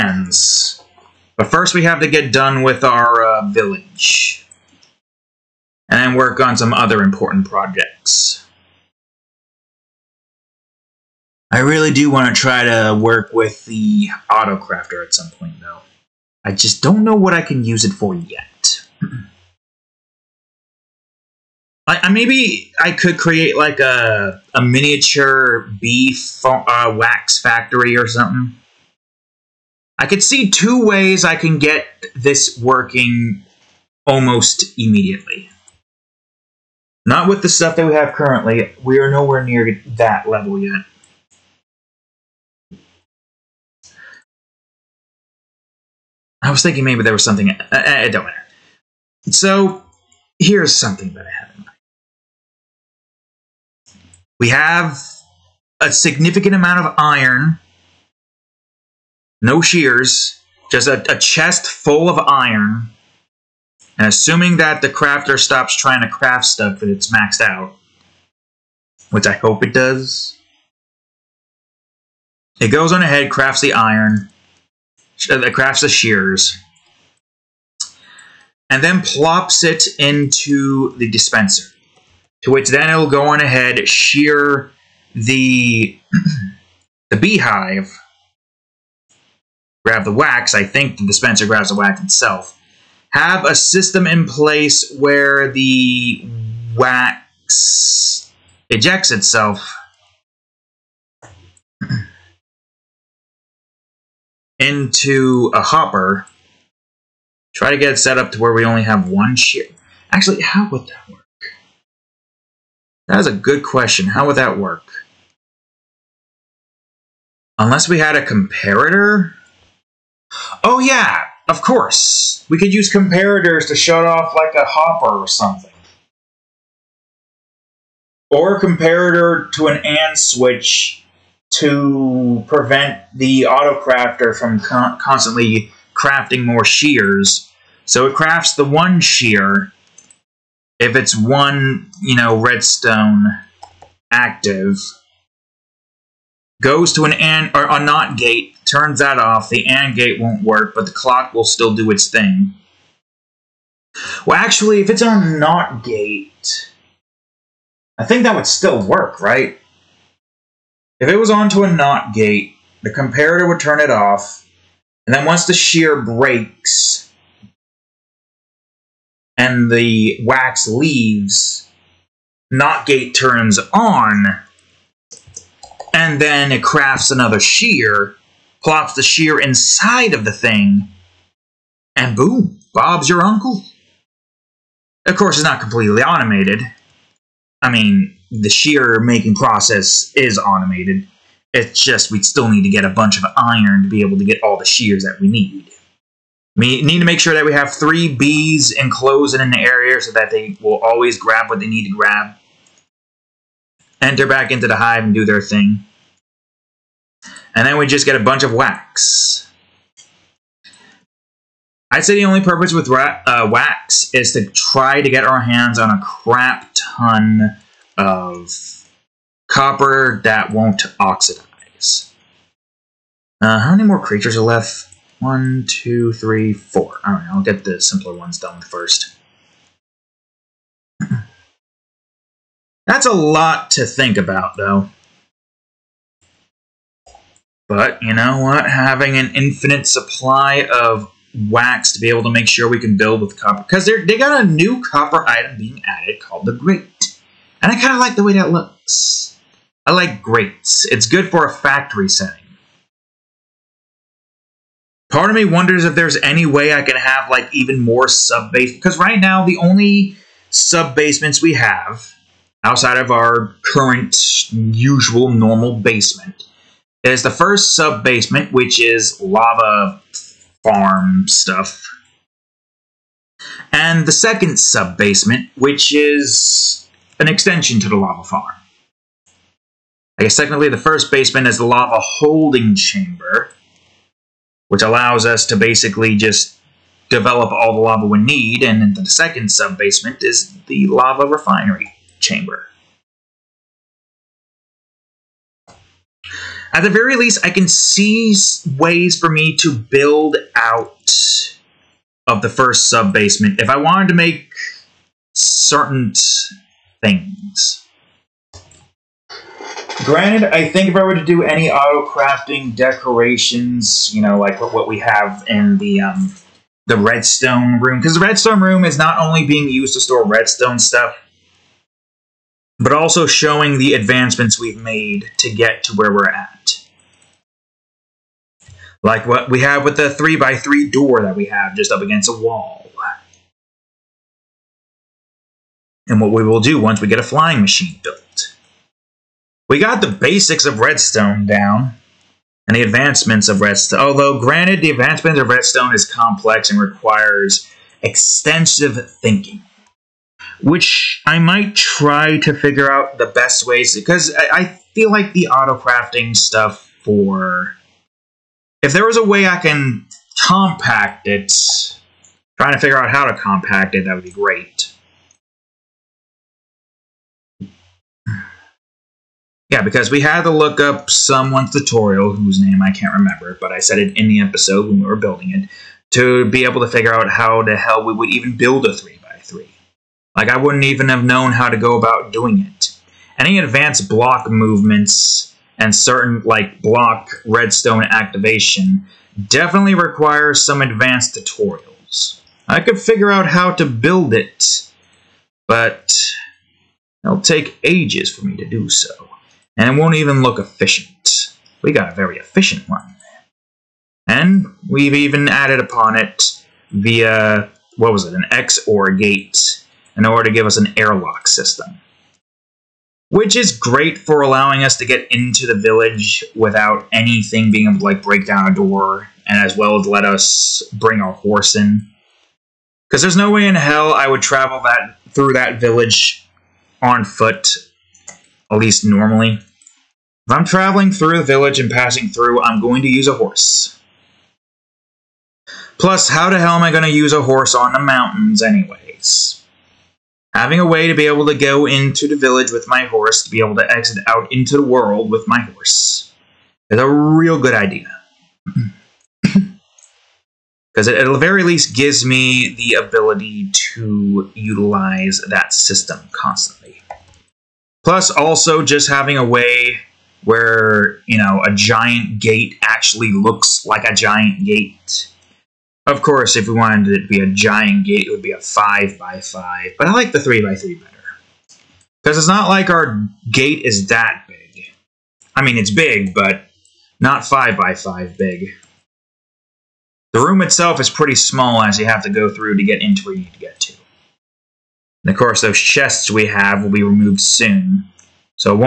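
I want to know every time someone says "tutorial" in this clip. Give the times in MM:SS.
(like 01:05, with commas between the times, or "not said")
06:11, 06:31.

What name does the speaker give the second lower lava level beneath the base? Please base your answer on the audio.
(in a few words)
Lava refinery chamber.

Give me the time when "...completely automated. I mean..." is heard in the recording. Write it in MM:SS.
03:05.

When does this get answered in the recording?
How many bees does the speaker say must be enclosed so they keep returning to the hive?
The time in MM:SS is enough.
03:17.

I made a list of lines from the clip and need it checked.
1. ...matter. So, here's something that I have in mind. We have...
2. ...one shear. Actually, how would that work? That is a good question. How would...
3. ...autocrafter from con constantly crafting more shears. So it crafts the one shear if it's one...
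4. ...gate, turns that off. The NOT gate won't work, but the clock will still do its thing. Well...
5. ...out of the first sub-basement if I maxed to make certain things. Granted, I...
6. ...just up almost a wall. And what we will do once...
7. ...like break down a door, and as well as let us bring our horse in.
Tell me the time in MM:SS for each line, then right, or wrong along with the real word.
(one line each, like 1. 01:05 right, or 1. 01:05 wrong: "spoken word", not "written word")
1. 00:48 right
2. 01:49 right
3. 02:13 right
4. 02:28 wrong: "AND", not "NOT"
5. 05:00 wrong: "wanted", not "maxed"
6. 05:31 wrong: "against", not "almost"
7. 06:58 right.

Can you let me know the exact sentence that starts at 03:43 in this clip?
Uh, how many more creatures are left?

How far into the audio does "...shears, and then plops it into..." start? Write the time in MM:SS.
01:15.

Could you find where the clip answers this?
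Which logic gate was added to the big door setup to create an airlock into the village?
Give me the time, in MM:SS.
06:48.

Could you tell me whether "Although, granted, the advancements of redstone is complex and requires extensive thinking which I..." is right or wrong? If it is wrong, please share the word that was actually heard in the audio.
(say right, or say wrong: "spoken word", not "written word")
right.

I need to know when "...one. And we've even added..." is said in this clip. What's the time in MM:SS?
06:42.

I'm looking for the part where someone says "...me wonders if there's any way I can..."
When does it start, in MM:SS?
04:15.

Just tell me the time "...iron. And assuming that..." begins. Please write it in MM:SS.
01:02.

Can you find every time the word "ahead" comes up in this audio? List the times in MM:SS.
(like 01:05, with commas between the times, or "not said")
01:13, 01:23.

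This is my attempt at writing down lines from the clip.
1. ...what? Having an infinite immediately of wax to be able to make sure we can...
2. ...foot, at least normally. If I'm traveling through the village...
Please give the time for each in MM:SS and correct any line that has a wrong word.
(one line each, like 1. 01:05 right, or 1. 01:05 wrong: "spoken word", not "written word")
1. 03:58 wrong: "supply", not "immediately"
2. 07:07 right.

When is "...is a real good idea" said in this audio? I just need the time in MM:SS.
07:26.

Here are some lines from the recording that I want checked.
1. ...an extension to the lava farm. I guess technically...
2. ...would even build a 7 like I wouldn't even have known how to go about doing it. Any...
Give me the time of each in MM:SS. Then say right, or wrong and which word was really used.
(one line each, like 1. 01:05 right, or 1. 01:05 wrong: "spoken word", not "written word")
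1. 04:37 right
2. 06:18 wrong: "3", not "7".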